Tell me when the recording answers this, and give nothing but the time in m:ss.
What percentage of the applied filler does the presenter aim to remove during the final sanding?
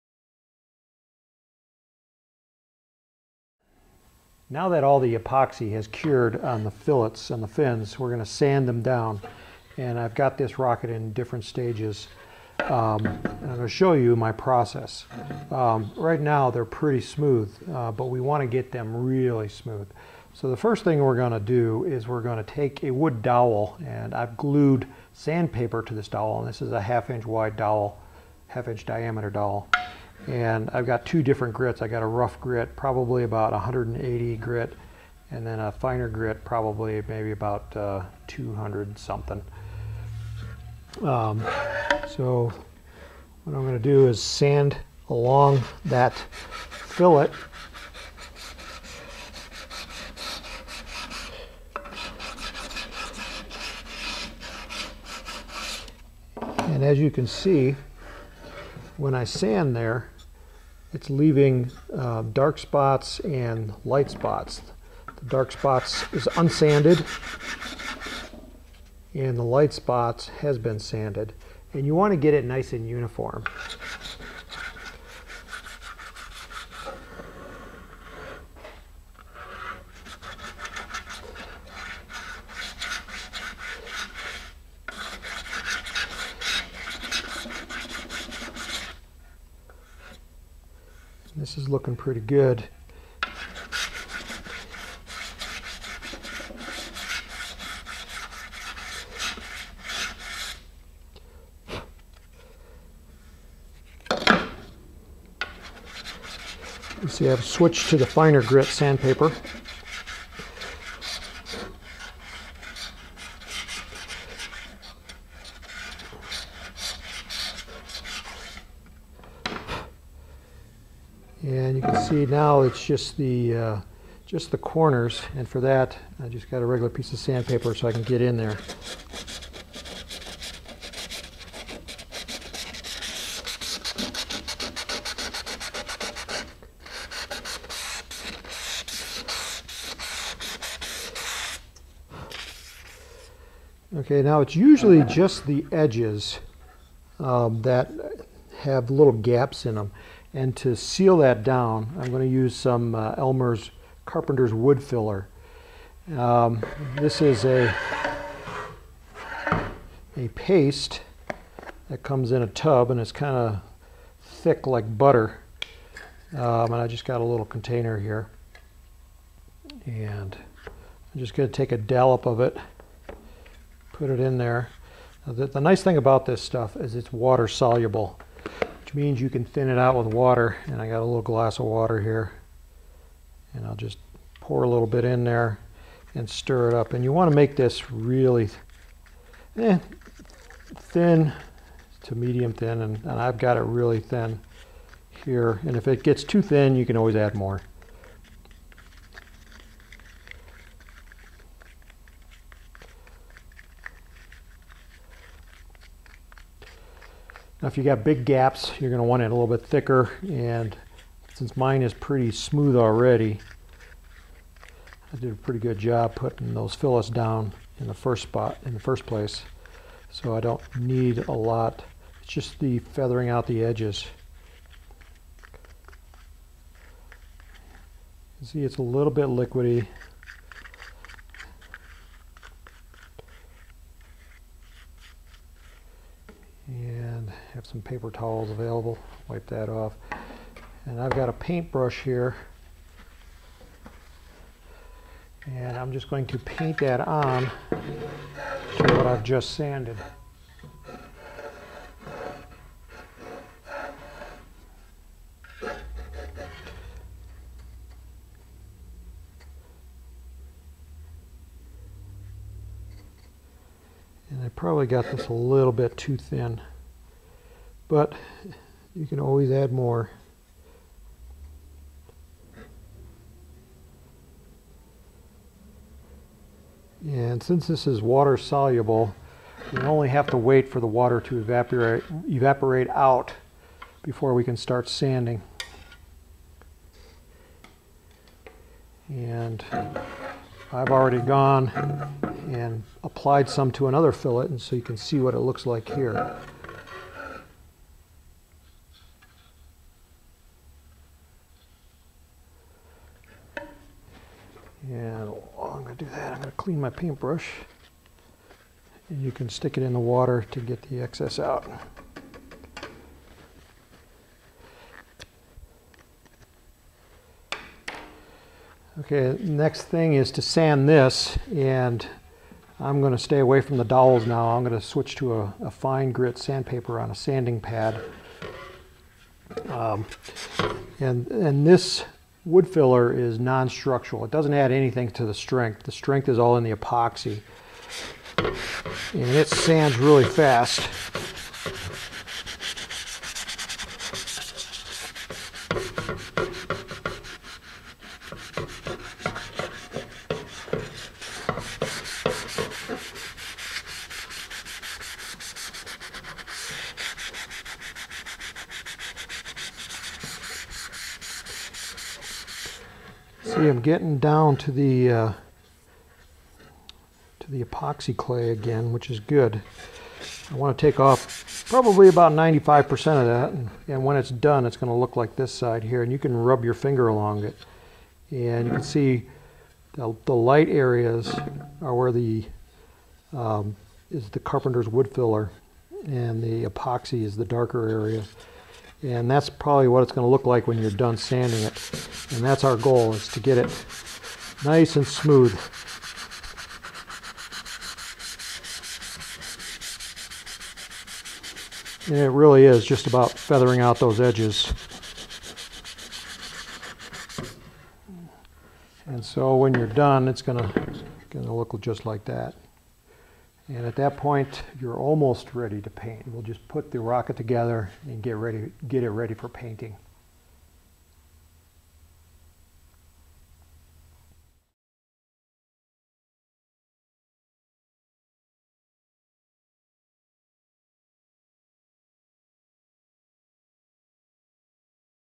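6:12.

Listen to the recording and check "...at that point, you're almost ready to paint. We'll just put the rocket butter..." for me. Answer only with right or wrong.
wrong.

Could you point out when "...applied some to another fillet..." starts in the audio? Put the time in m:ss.
4:53.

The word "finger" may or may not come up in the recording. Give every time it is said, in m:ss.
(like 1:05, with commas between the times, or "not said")
6:16.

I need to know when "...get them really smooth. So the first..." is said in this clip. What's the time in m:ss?
0:18.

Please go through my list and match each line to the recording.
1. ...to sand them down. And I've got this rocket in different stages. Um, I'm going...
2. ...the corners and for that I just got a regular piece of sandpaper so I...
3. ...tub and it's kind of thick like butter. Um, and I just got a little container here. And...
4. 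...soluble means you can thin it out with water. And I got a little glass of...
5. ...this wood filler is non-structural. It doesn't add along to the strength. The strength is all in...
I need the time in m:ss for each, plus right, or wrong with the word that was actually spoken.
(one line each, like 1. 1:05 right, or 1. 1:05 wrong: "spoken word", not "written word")
1. 0:08 right
2. 2:04 right
3. 2:42 right
4. 2:57 right
5. 5:31 wrong: "anything", not "along".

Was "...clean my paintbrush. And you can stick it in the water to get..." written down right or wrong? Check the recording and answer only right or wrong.
right.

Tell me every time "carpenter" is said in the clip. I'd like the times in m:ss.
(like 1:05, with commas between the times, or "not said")
2:34, 6:24.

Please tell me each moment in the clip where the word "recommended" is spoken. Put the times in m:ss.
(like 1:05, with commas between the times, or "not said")
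not said.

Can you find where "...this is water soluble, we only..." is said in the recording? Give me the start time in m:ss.
4:37.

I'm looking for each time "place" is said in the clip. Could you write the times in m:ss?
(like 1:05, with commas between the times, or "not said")
3:39.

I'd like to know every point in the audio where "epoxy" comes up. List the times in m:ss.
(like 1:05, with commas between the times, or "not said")
0:05, 5:36, 6:07, 6:26.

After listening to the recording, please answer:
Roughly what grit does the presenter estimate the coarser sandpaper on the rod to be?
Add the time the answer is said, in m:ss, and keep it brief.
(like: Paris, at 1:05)
180, at 0:33.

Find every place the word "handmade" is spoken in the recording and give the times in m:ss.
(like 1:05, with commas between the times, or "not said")
not said.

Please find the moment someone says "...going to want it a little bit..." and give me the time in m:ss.
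3:28.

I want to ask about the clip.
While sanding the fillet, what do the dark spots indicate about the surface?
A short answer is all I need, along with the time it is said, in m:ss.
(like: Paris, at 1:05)
unsanded, at 1:06.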